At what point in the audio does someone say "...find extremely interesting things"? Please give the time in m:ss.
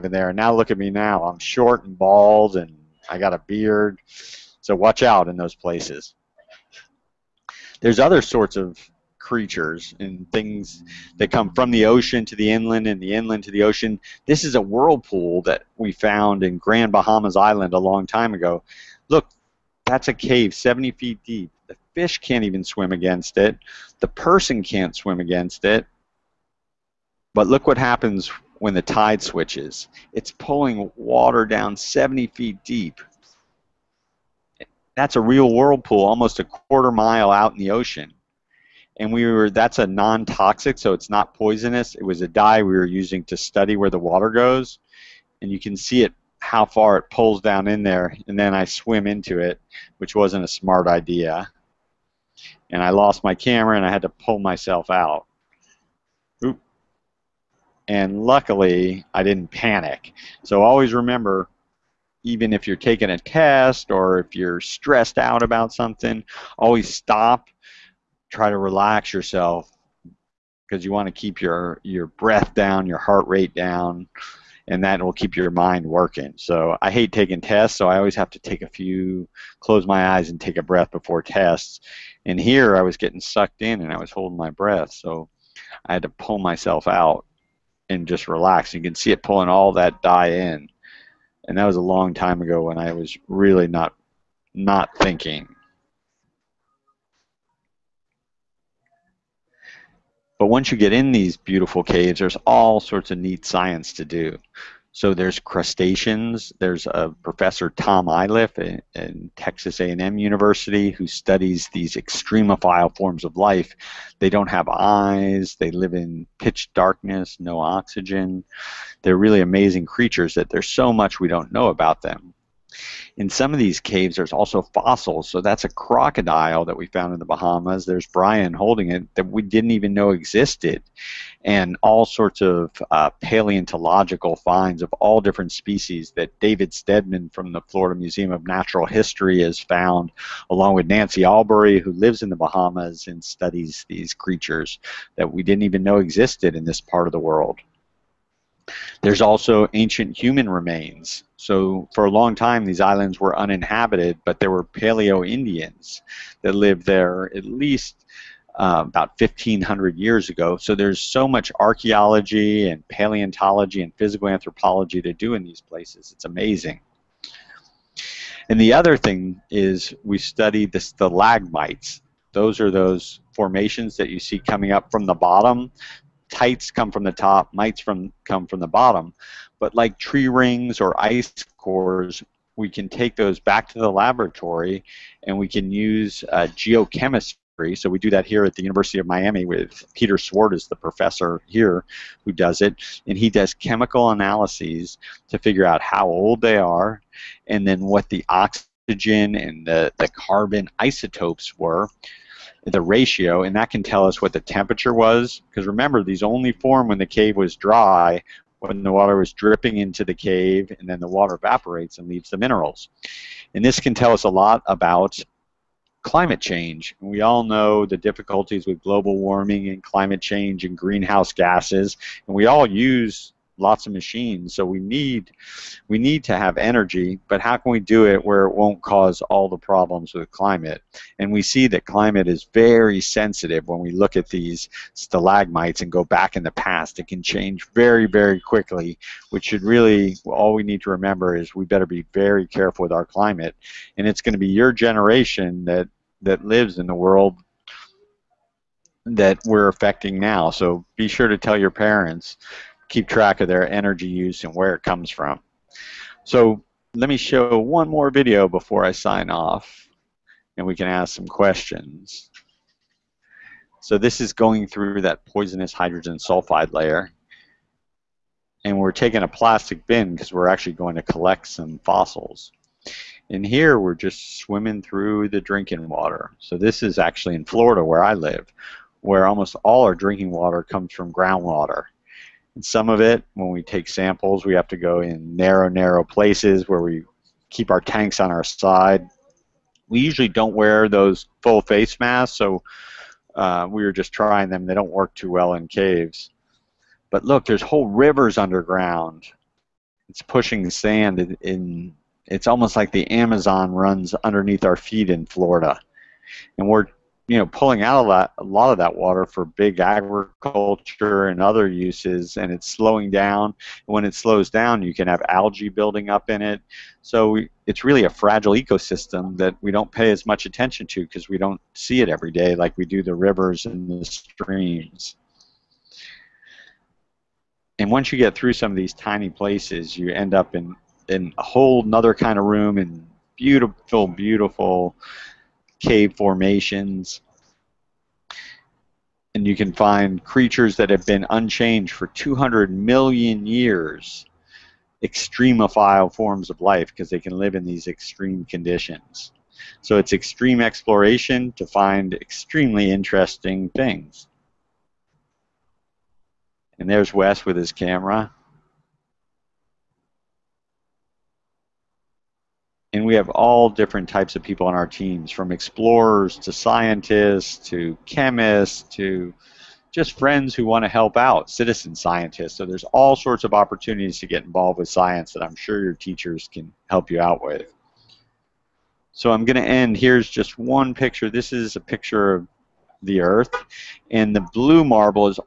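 5:51.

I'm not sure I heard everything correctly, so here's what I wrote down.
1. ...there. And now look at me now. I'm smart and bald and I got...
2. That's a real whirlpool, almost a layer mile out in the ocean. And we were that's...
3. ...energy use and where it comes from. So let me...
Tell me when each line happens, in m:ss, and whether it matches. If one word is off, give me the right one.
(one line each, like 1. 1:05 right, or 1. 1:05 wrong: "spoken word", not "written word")
1. 0:00 wrong: "short", not "smart"
2. 0:34 wrong: "quarter", not "layer"
3. 4:13 right.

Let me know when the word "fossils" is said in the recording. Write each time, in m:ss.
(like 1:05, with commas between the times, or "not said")
2:04, 4:31.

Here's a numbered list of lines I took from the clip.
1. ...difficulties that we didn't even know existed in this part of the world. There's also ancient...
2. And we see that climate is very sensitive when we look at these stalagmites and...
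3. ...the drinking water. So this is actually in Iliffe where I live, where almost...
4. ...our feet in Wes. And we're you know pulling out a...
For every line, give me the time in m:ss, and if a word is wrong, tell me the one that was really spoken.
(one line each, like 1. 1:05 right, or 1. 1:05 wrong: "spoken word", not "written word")
1. 2:24 wrong: "creatures", not "difficulties"
2. 3:51 right
3. 4:35 wrong: "Florida", not "Iliffe"
4. 5:04 wrong: "Florida", not "Wes".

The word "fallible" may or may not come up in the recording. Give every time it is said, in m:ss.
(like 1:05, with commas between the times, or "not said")
not said.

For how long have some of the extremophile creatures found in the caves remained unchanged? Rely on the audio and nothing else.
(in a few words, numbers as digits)
200 million years.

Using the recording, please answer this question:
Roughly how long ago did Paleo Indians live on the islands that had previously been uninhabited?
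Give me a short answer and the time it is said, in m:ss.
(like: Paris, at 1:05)
1500 years, at 2:39.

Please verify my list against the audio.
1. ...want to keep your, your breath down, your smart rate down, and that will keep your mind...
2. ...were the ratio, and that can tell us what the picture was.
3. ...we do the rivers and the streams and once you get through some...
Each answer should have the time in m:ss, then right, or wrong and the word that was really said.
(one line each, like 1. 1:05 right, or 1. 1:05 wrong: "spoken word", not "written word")
1. 1:10 wrong: "heart", not "smart"
2. 3:21 wrong: "temperature", not "picture"
3. 5:22 right.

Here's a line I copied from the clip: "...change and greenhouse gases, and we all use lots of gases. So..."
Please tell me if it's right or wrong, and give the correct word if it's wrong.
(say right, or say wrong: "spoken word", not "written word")
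wrong: "machines", not "gases".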